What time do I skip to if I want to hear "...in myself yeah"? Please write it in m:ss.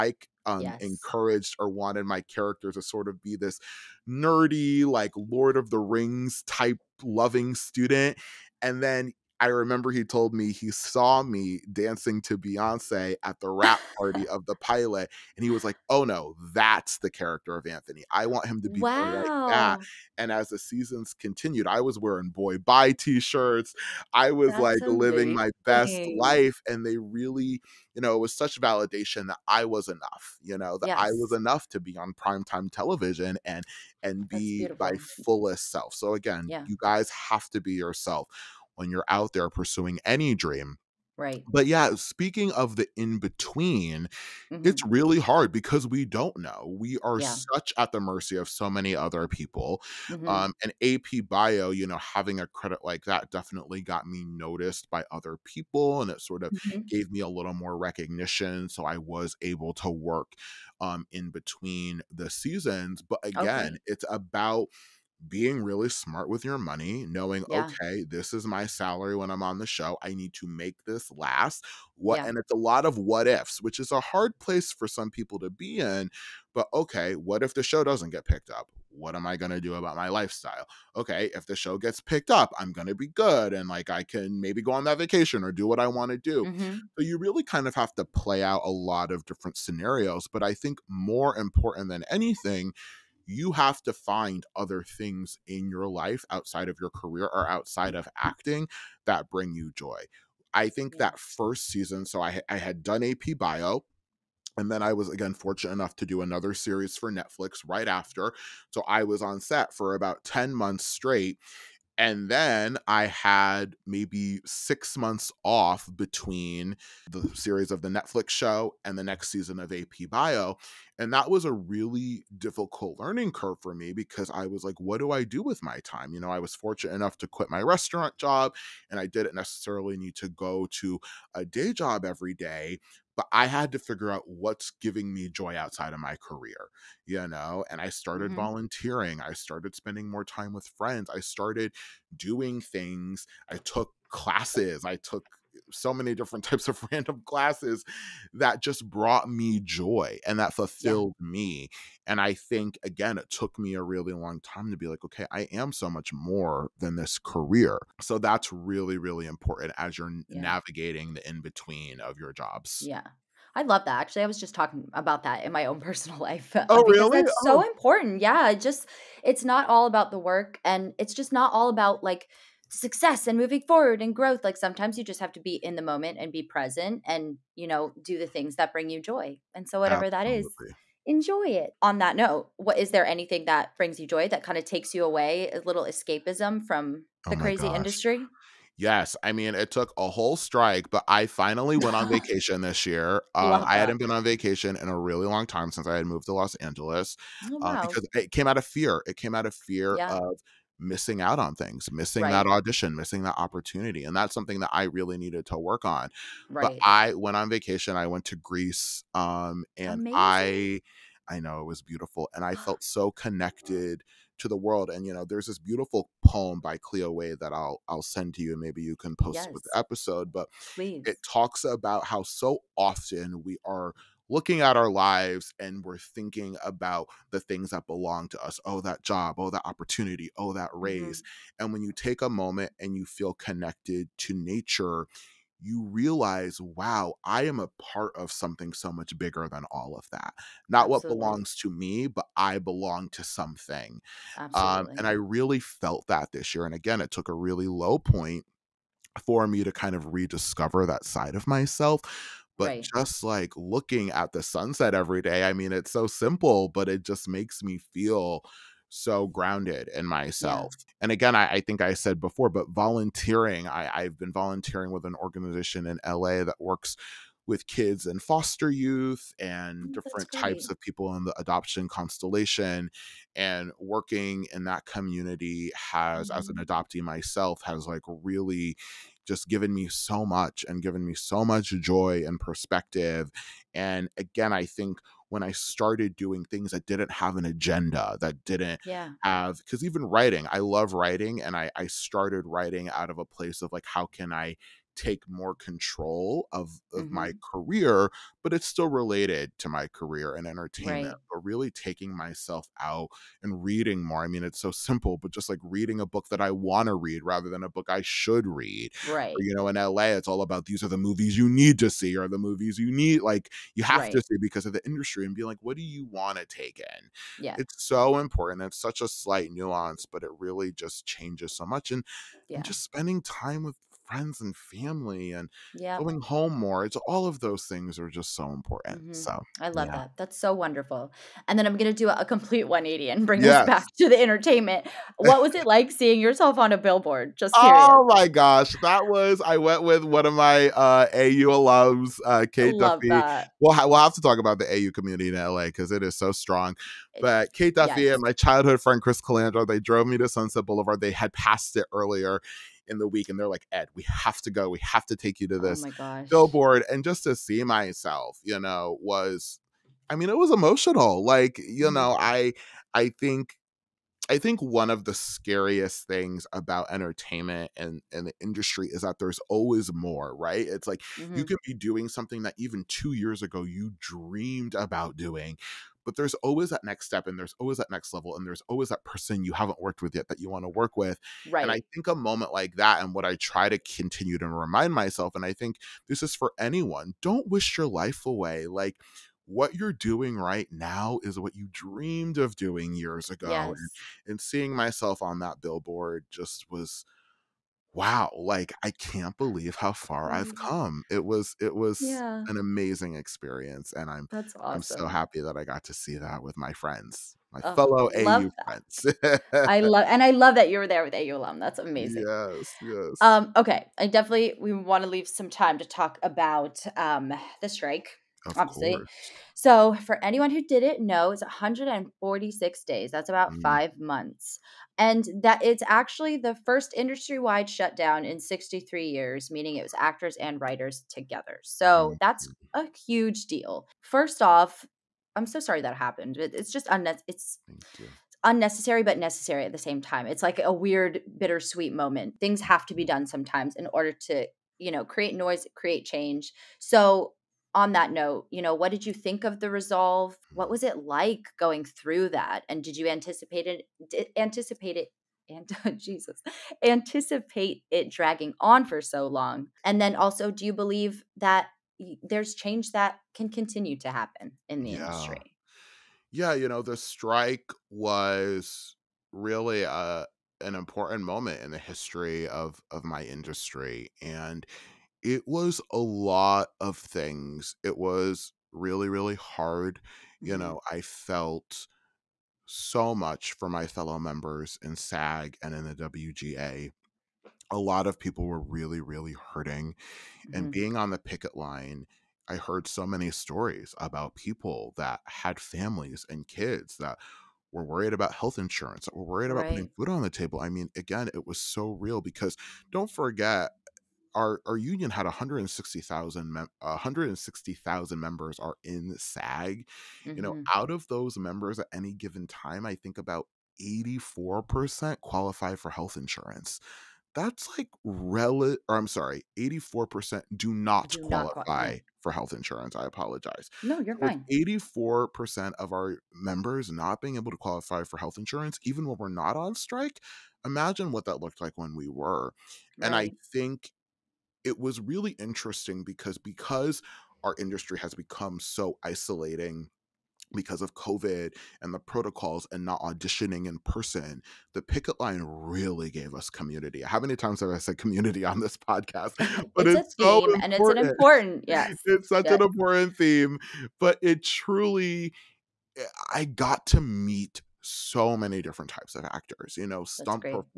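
4:19.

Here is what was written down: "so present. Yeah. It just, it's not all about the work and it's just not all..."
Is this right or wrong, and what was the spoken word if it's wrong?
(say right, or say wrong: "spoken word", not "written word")
wrong: "important", not "present".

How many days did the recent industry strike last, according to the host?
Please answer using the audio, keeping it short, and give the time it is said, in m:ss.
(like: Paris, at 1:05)
146, at 7:01.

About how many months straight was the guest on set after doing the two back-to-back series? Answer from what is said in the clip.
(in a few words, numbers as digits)
10.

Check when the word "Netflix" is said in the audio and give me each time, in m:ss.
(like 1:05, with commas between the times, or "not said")
1:47, 1:57.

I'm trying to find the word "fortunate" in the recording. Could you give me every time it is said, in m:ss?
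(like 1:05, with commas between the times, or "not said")
1:45, 2:06.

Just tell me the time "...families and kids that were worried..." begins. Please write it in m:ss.
8:15.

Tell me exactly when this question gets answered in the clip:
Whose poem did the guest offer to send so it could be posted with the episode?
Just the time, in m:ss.
3:36.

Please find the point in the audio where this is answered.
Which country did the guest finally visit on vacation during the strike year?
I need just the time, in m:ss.
3:28.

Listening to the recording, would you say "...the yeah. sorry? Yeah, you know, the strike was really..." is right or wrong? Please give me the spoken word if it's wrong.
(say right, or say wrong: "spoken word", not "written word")
wrong: "industry", not "sorry".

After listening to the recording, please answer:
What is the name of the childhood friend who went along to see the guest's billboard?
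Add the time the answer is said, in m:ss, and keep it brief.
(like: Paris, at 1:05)
Chris Calandro, at 5:49.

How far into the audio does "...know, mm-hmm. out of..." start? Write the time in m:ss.
8:30.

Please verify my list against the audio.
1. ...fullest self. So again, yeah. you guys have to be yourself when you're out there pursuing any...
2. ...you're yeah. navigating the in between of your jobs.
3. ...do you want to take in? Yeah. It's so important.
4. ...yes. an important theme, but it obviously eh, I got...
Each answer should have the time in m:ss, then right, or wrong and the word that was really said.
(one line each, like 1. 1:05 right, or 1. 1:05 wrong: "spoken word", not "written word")
1. 0:35 right
2. 2:39 right
3. 5:15 right
4. 9:12 wrong: "truly", not "obviously".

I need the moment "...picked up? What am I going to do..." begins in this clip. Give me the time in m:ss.
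1:18.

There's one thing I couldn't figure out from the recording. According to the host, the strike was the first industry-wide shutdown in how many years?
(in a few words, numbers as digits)
63.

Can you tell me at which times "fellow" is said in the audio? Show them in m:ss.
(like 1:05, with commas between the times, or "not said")
6:47, 8:03.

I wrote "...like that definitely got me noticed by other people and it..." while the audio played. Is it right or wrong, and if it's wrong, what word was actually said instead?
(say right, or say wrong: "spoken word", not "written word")
right.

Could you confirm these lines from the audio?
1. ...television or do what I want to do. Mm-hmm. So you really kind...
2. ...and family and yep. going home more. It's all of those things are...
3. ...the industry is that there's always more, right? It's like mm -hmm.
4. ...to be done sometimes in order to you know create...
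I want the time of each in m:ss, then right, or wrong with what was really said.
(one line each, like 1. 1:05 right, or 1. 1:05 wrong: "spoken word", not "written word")
1. 1:24 wrong: "vacation", not "television"
2. 5:24 right
3. 6:08 right
4. 7:22 right.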